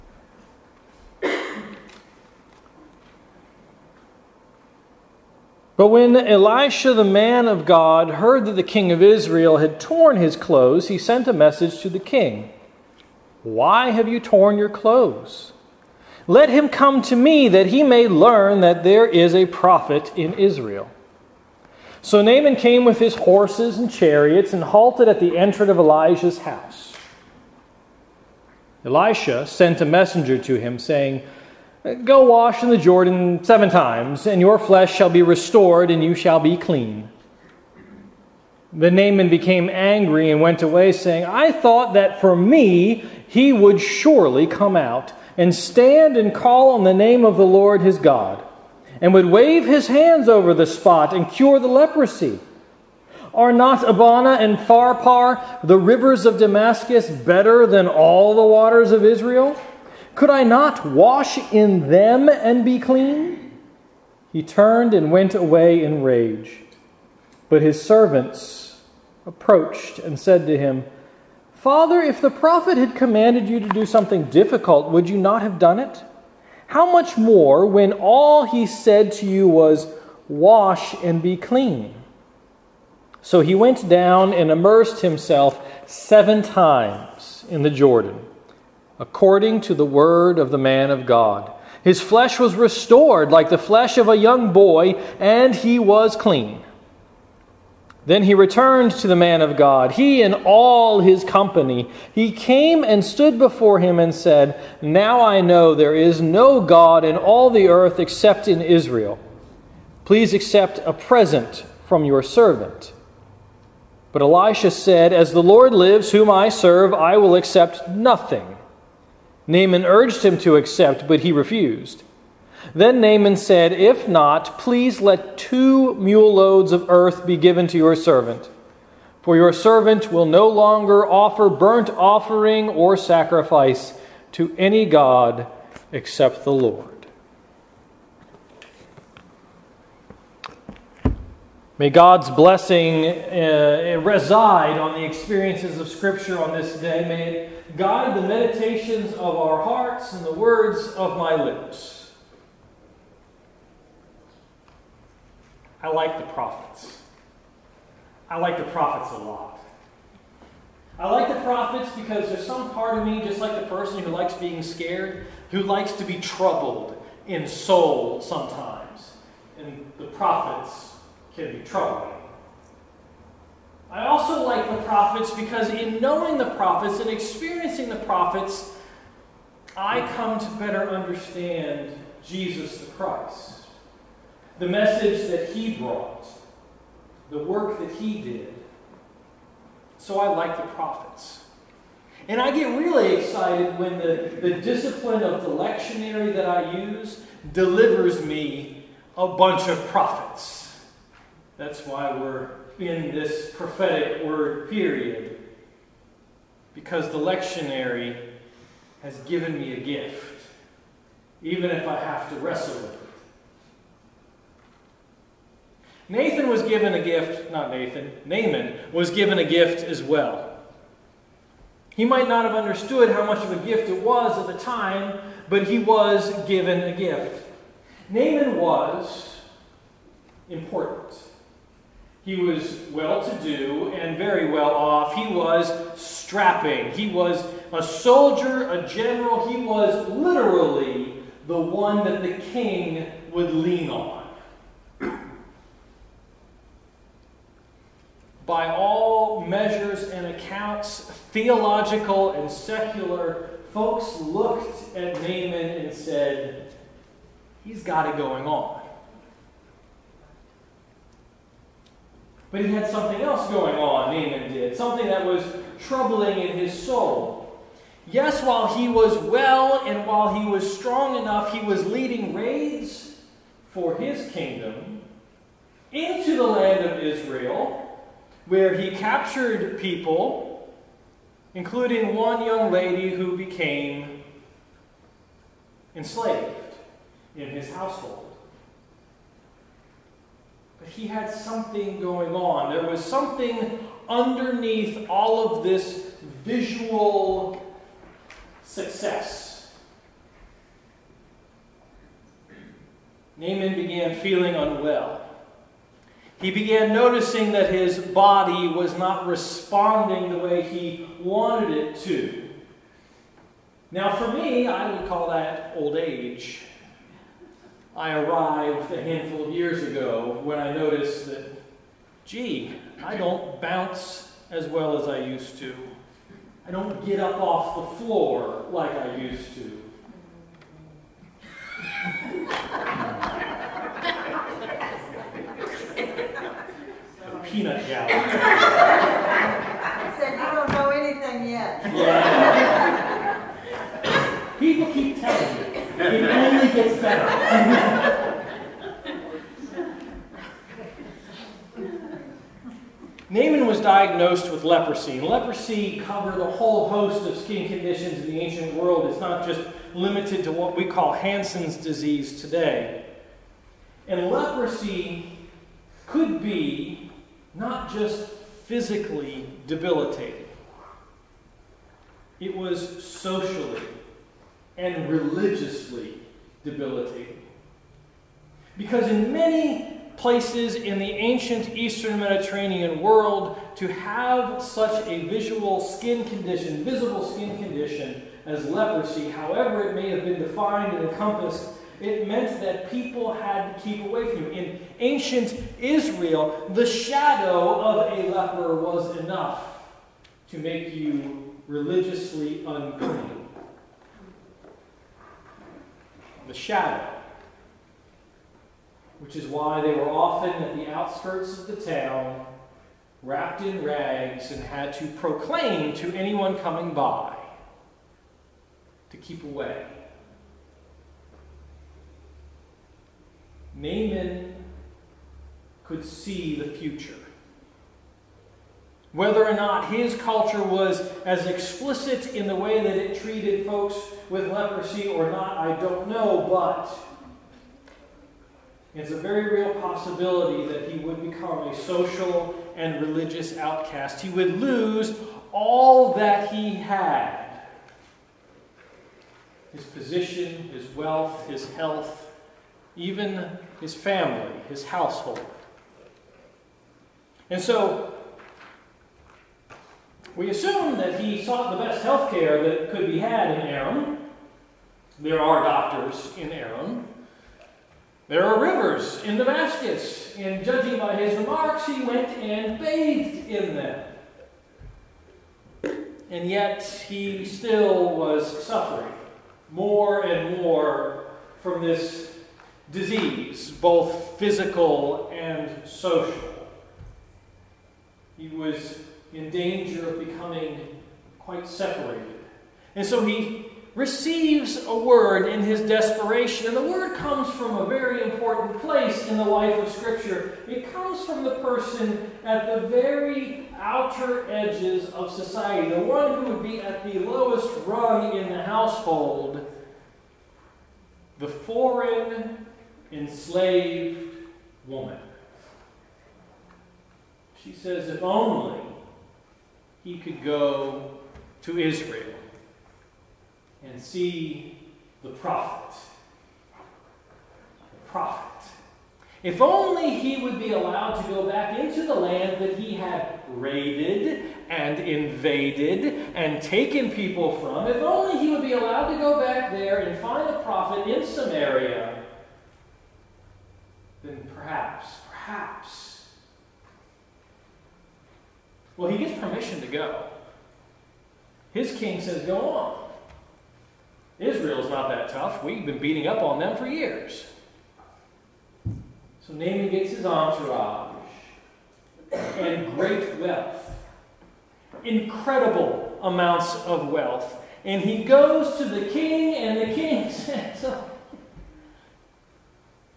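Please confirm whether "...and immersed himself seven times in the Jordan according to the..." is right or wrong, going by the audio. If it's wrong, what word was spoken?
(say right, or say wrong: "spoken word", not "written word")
right.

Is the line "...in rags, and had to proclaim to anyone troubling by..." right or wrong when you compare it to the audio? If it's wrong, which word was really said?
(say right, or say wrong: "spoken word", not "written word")
wrong: "coming", not "troubling".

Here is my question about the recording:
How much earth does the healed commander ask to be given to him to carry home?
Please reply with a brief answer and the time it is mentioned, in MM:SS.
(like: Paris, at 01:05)
Two mule loads, at 02:05.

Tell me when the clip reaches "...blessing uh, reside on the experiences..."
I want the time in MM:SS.
02:22.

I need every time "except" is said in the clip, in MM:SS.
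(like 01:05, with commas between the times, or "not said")
01:47, 02:15.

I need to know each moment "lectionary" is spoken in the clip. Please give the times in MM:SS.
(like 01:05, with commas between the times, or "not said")
03:15, 03:27.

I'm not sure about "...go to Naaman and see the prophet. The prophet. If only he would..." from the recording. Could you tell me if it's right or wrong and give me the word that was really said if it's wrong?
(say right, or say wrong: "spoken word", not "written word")
wrong: "Israel", not "Naaman".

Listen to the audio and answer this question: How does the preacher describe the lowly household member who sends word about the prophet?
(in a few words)
Foreign, enslaved woman.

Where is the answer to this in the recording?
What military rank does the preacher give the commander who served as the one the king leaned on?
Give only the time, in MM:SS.
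03:58.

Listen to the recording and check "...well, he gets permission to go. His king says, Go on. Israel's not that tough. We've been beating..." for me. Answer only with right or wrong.
right.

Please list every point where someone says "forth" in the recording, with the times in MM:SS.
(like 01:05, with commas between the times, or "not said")
not said.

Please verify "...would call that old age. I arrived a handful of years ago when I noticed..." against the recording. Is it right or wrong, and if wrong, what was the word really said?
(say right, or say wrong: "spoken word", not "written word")
right.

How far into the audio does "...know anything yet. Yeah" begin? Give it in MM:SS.
05:40.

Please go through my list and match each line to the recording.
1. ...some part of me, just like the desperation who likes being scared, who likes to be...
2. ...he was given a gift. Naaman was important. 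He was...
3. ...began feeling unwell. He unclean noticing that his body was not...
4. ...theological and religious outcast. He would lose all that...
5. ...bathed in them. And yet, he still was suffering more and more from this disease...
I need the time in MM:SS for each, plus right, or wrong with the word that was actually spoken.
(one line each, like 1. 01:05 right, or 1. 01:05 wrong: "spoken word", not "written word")
1. 02:42 wrong: "person", not "desperation"
2. 03:45 right
3. 05:03 wrong: "began", not "unclean"
4. 07:21 wrong: "social", not "theological"
5. 07:52 right.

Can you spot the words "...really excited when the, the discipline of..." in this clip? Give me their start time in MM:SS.
03:12.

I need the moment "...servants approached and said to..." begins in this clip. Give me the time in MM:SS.
01:07.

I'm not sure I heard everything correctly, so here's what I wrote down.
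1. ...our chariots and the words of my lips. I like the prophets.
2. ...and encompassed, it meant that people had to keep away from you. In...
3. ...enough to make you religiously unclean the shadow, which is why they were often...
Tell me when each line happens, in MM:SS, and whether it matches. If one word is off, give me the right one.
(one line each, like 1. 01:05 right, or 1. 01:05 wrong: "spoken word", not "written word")
1. 02:29 wrong: "hearts", not "chariots"
2. 06:30 right
3. 06:39 right.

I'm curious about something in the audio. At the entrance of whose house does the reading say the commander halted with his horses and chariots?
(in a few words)
Elijah's house.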